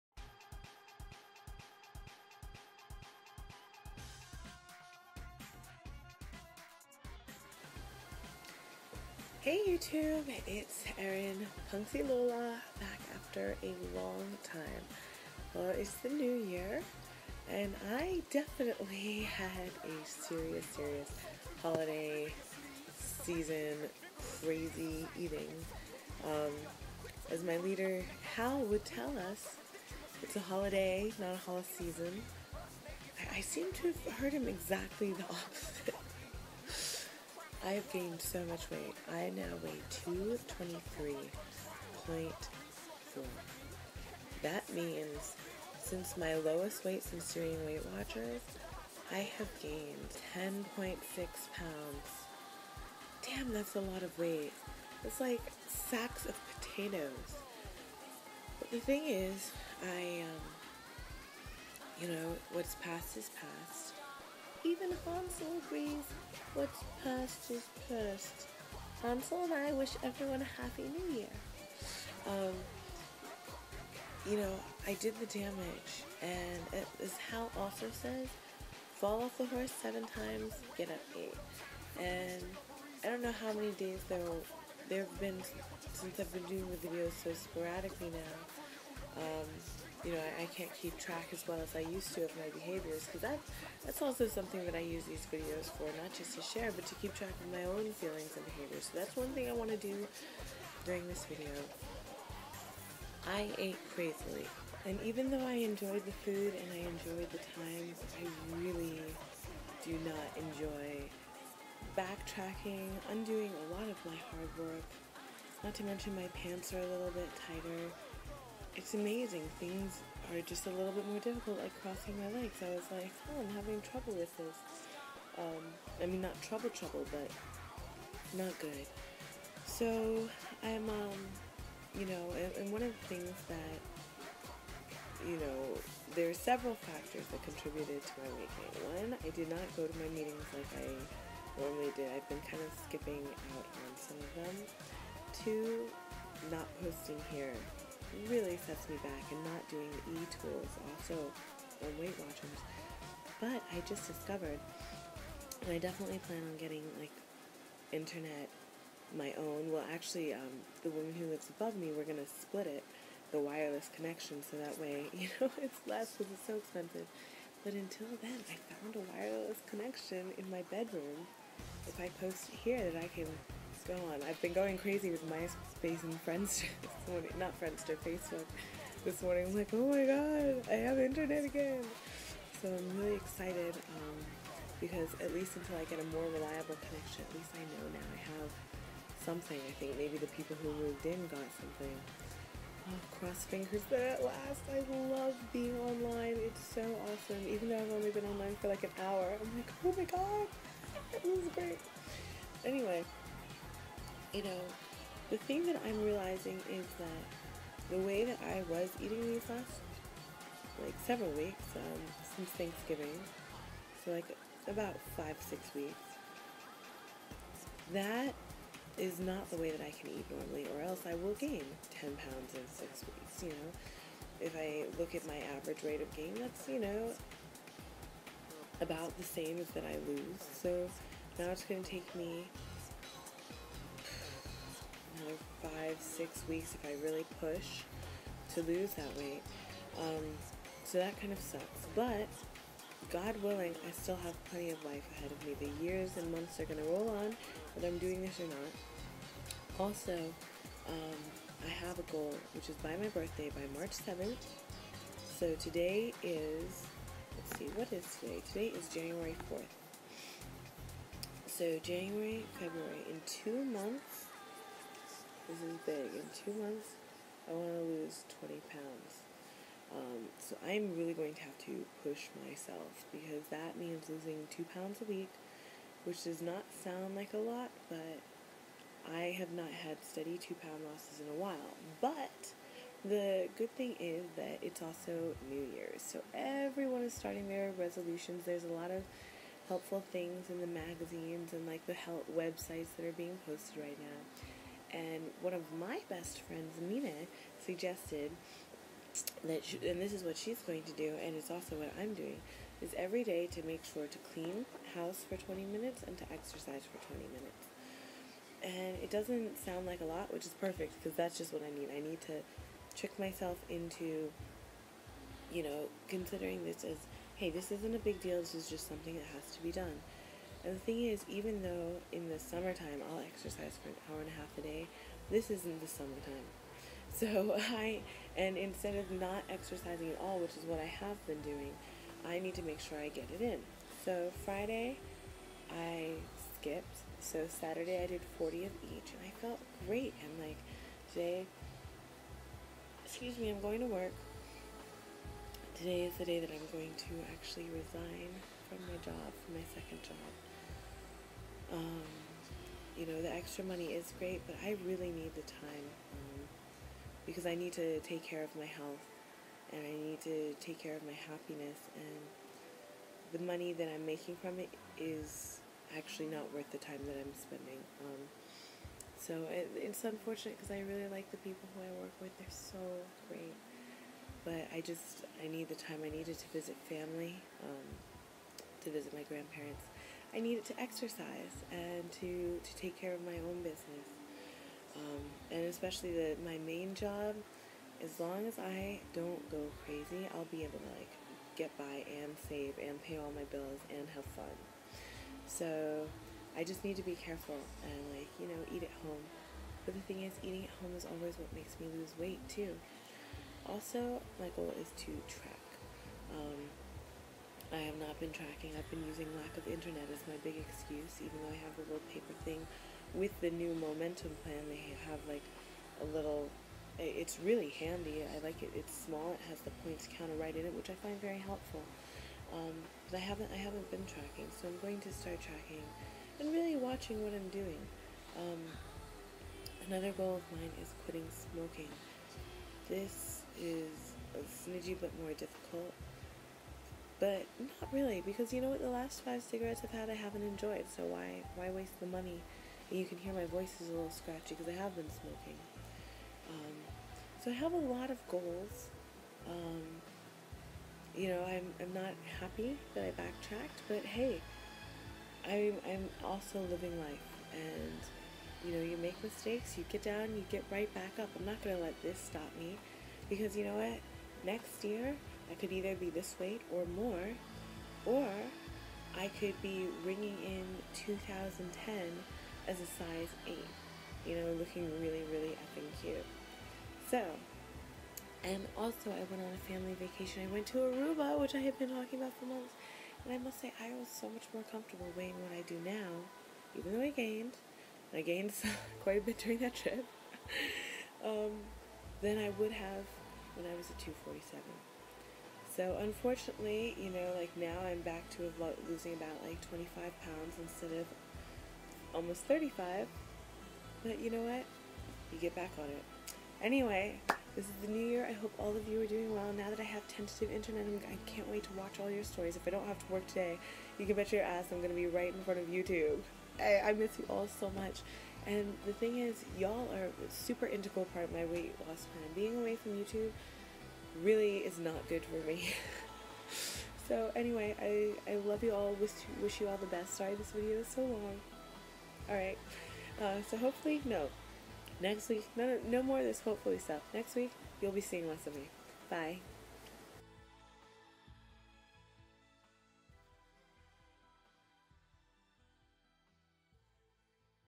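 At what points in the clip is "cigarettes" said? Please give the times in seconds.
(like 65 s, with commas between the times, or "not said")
439 s.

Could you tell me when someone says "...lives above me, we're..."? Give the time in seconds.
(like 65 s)
161 s.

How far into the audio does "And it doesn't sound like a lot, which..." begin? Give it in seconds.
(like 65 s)
308 s.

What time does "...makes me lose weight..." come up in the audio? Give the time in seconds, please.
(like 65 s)
401 s.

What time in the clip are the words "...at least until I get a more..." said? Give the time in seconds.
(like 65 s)
185 s.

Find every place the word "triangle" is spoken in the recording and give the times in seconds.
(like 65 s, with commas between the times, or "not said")
not said.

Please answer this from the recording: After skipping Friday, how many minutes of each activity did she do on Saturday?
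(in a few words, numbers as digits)
40.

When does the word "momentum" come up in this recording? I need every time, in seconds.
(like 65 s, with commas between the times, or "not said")
413 s.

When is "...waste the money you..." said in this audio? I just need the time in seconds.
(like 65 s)
441 s.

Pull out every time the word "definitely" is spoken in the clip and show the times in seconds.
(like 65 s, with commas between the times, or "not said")
18 s, 155 s.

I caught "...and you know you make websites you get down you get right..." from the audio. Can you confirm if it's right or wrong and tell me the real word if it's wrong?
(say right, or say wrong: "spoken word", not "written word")
wrong: "mistakes", not "websites".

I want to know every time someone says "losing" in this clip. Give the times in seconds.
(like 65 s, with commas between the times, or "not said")
274 s, 498 s.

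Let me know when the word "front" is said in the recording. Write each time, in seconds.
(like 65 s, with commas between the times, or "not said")
515 s.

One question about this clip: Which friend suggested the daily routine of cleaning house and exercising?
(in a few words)
Mina.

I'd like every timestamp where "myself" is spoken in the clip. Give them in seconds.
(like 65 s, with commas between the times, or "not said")
272 s, 313 s.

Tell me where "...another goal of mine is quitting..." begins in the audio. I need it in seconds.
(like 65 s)
429 s.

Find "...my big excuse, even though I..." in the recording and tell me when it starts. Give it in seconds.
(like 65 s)
410 s.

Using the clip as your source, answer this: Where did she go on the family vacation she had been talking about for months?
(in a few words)
Aruba.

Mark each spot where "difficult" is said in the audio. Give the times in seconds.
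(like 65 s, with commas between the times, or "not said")
121 s, 435 s.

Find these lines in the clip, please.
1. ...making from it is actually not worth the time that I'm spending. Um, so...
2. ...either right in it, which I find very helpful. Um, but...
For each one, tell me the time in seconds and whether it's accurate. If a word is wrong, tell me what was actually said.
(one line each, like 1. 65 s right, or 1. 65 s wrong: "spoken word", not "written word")
1. 364 s right
2. 420 s wrong: "counter", not "either".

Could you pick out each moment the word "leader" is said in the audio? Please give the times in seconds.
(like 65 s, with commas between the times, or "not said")
27 s.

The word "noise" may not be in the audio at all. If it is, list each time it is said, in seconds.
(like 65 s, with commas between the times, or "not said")
not said.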